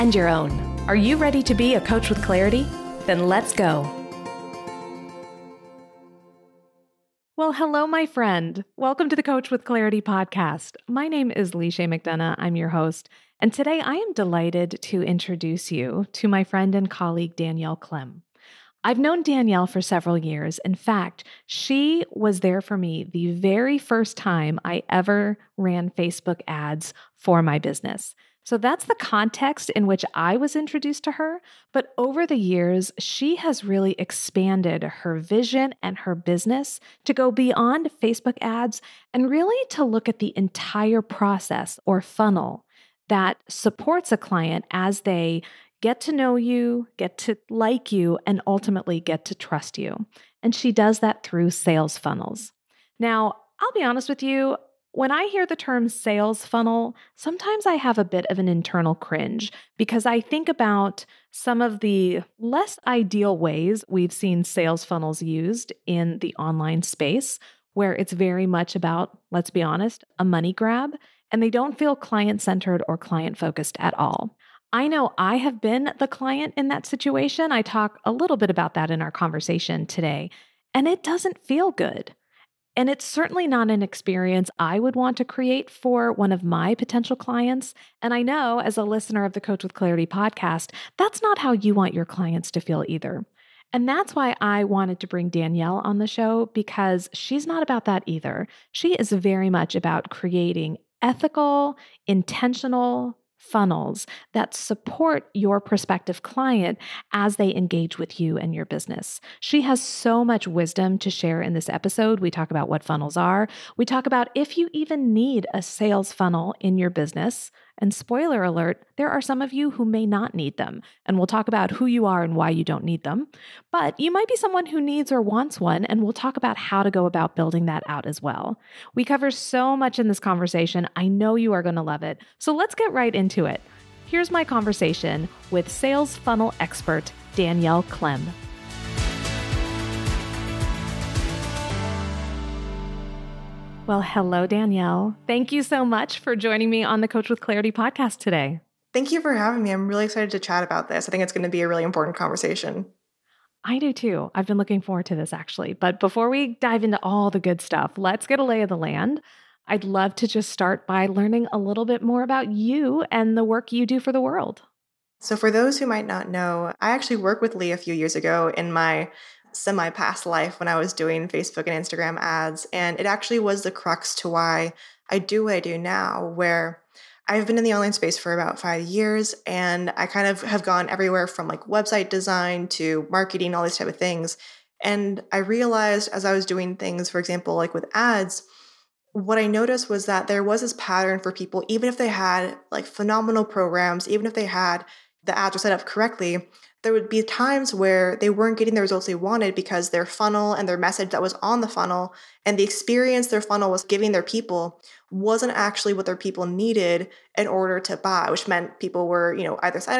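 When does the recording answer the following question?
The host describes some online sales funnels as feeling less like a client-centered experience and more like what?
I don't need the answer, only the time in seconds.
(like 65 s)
70 s.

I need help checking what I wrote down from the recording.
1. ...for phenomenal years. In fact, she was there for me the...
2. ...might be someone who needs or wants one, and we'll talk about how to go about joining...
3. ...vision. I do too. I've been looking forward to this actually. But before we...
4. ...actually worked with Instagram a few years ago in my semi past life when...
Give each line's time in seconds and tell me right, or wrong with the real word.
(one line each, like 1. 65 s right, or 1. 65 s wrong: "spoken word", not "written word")
1. 19 s wrong: "several", not "phenomenal"
2. 124 s wrong: "building", not "joining"
3. 152 s wrong: "conversation", not "vision"
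4. 166 s wrong: "Lee", not "Instagram".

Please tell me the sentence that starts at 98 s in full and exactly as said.
She is very much about creating ethical, intentional, funnels that support your prospective client as they engage with you and your business.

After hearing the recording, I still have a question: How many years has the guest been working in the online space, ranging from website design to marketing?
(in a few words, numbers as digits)
5.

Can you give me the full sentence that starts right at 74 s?
I know I have been the client in that situation.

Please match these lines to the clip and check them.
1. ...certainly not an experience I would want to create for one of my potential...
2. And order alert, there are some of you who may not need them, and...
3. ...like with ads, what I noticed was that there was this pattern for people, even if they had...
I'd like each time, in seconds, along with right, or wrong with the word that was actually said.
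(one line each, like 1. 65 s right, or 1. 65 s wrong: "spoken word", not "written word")
1. 83 s right
2. 117 s wrong: "spoiler", not "order"
3. 187 s right.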